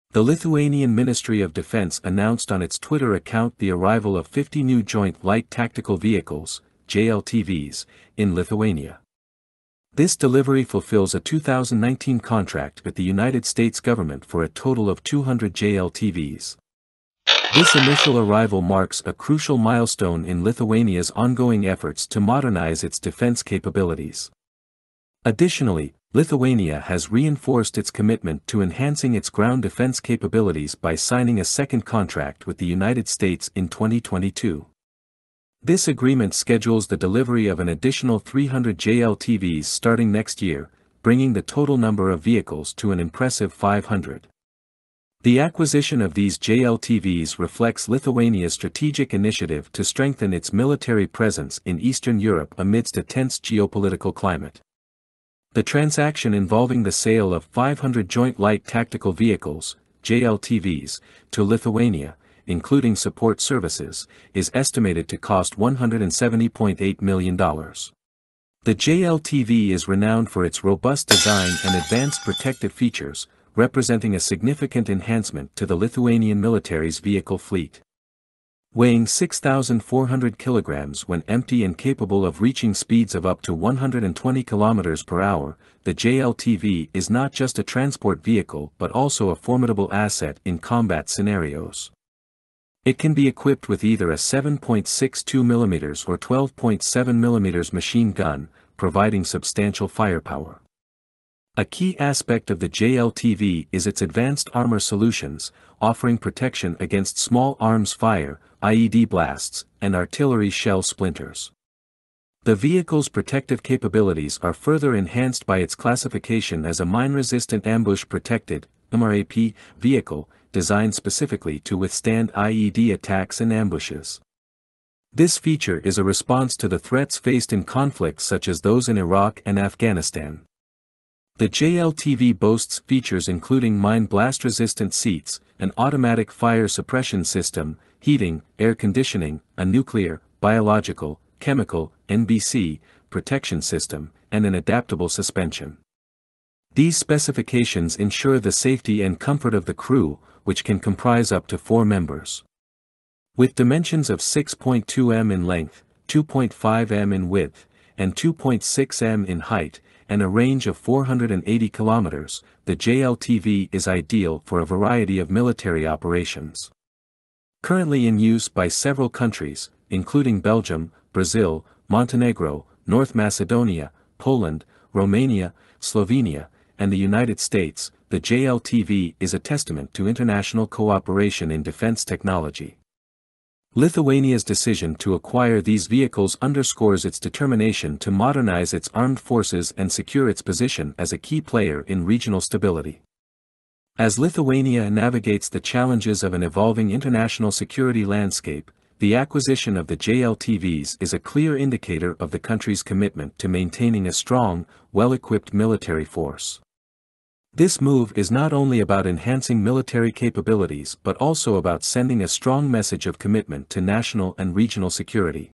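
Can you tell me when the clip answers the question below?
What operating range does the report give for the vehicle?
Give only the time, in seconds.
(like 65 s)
160 s.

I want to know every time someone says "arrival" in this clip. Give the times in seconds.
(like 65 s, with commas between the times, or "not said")
3 s, 18 s.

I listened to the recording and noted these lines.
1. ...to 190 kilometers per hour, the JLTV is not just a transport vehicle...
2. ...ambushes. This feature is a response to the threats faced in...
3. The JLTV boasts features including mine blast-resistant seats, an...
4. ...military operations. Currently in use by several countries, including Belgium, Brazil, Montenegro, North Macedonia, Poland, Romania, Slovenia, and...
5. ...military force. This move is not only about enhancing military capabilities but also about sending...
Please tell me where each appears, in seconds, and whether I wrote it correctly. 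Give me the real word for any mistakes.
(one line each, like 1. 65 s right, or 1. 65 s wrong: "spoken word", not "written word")
1. 83 s wrong: "120", not "190"
2. 123 s right
3. 131 s right
4. 165 s right
5. 205 s right.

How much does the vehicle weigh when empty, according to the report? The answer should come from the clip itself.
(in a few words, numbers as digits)
6,400 kilograms.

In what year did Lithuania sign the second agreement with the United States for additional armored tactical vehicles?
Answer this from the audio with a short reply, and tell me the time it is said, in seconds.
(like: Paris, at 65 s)
2022, at 33 s.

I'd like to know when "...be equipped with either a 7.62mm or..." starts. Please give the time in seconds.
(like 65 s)
93 s.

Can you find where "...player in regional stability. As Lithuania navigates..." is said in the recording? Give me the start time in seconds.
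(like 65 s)
191 s.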